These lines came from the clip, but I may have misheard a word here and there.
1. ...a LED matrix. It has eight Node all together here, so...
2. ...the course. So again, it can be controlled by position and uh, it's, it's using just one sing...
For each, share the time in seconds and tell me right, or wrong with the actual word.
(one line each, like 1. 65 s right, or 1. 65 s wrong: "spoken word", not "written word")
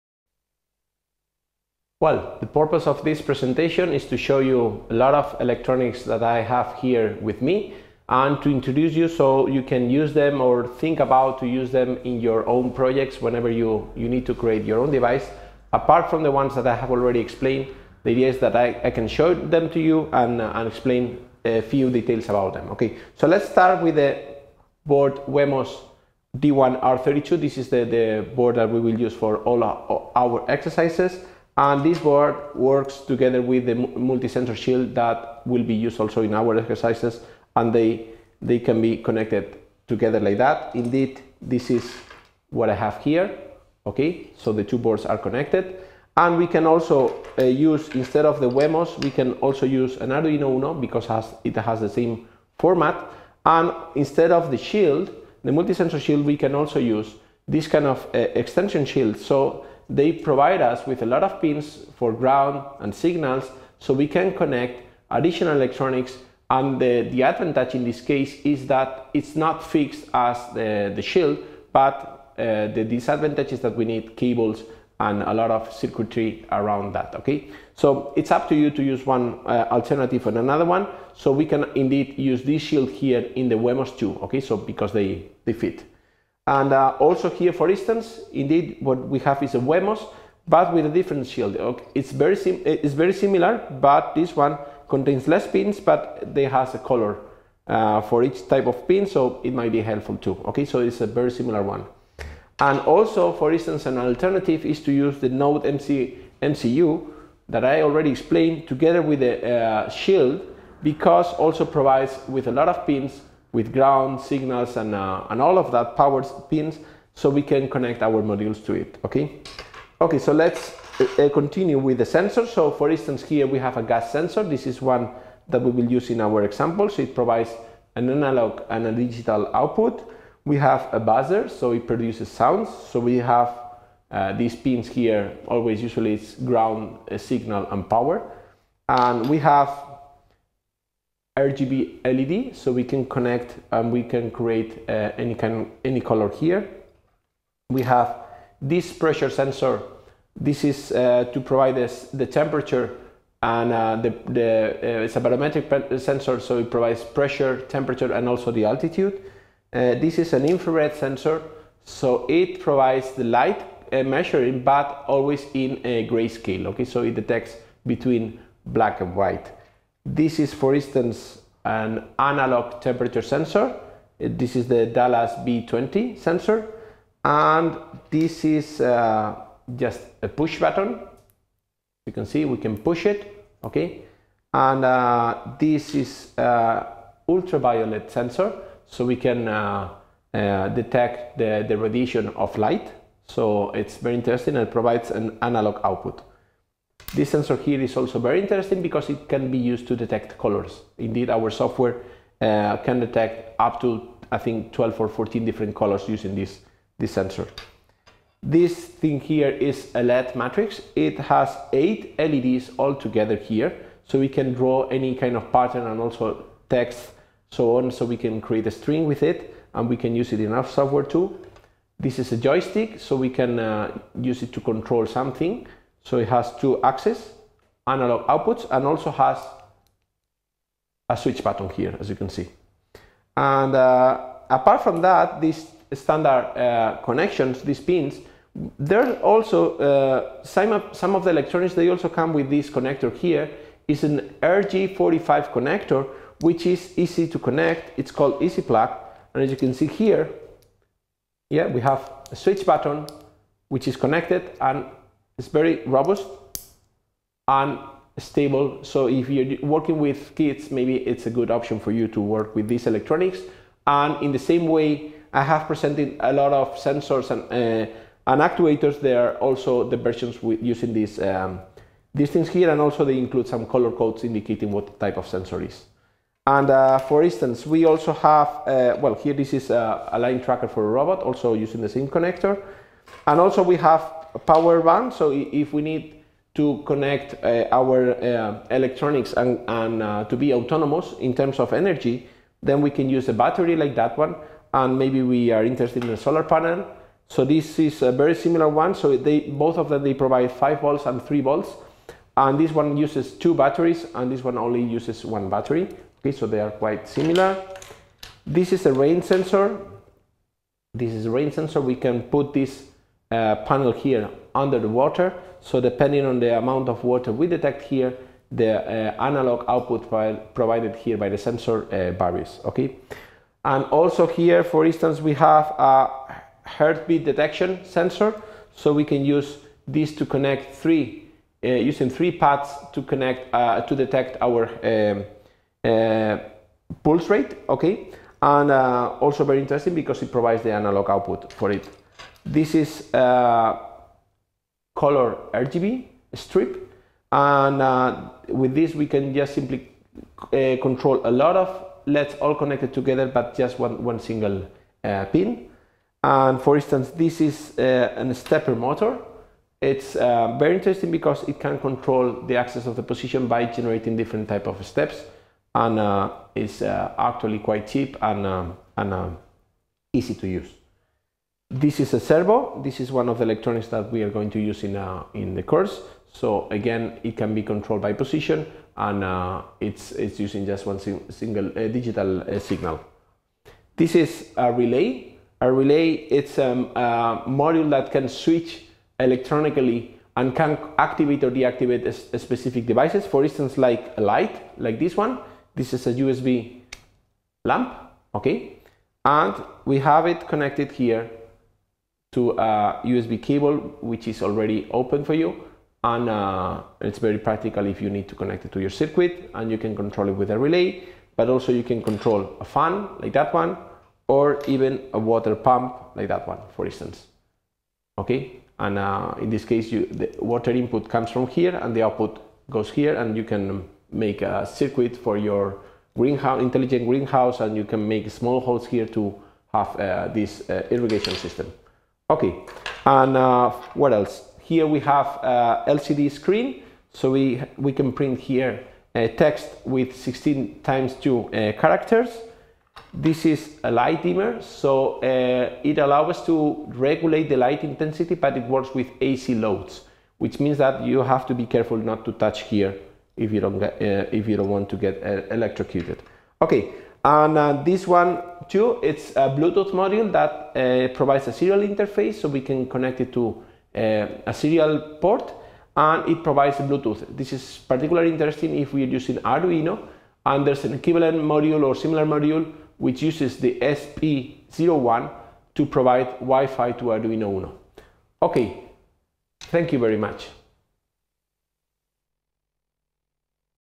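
1. 209 s wrong: "LEDs", not "Node"
2. 375 s right.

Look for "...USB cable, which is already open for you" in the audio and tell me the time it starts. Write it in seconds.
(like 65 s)
403 s.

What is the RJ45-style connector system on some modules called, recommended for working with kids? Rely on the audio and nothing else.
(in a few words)
Easy Plug.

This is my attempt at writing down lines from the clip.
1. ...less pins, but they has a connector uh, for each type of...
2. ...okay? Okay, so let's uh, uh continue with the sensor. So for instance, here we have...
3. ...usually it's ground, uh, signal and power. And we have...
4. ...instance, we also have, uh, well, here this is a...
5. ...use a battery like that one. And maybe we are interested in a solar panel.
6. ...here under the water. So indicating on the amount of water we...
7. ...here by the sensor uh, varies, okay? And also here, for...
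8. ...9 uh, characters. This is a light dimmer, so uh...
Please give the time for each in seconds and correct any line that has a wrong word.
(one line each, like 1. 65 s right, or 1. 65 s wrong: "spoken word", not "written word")
1. 95 s wrong: "color", not "connector"
2. 119 s right
3. 135 s right
4. 277 s right
5. 293 s right
6. 313 s wrong: "depending", not "indicating"
7. 320 s right
8. 441 s wrong: "2", not "9".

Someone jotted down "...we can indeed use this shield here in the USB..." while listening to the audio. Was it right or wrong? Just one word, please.
wrong.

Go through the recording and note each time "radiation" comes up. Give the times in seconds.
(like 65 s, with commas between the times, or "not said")
191 s.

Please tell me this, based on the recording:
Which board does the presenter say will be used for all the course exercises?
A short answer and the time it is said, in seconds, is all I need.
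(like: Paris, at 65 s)
Wemos D1R32, at 25 s.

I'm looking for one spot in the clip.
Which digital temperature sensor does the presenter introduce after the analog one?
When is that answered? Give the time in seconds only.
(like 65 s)
174 s.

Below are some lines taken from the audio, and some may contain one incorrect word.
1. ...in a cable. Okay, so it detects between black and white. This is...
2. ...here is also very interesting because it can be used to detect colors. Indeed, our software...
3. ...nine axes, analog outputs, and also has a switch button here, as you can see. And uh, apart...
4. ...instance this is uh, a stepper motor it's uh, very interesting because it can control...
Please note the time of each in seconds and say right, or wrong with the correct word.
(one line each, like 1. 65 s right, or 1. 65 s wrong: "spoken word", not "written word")
1. 165 s wrong: "grayscale", not "cable"
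2. 197 s right
3. 226 s wrong: "two", not "nine"
4. 356 s right.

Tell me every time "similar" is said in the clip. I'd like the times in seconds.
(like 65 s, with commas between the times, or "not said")
93 s, 101 s, 298 s, 307 s, 471 s.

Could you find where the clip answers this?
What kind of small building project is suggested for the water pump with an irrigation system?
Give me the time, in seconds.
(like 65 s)
426 s.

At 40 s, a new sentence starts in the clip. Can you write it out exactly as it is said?
Indeed, this is what I have here, okay?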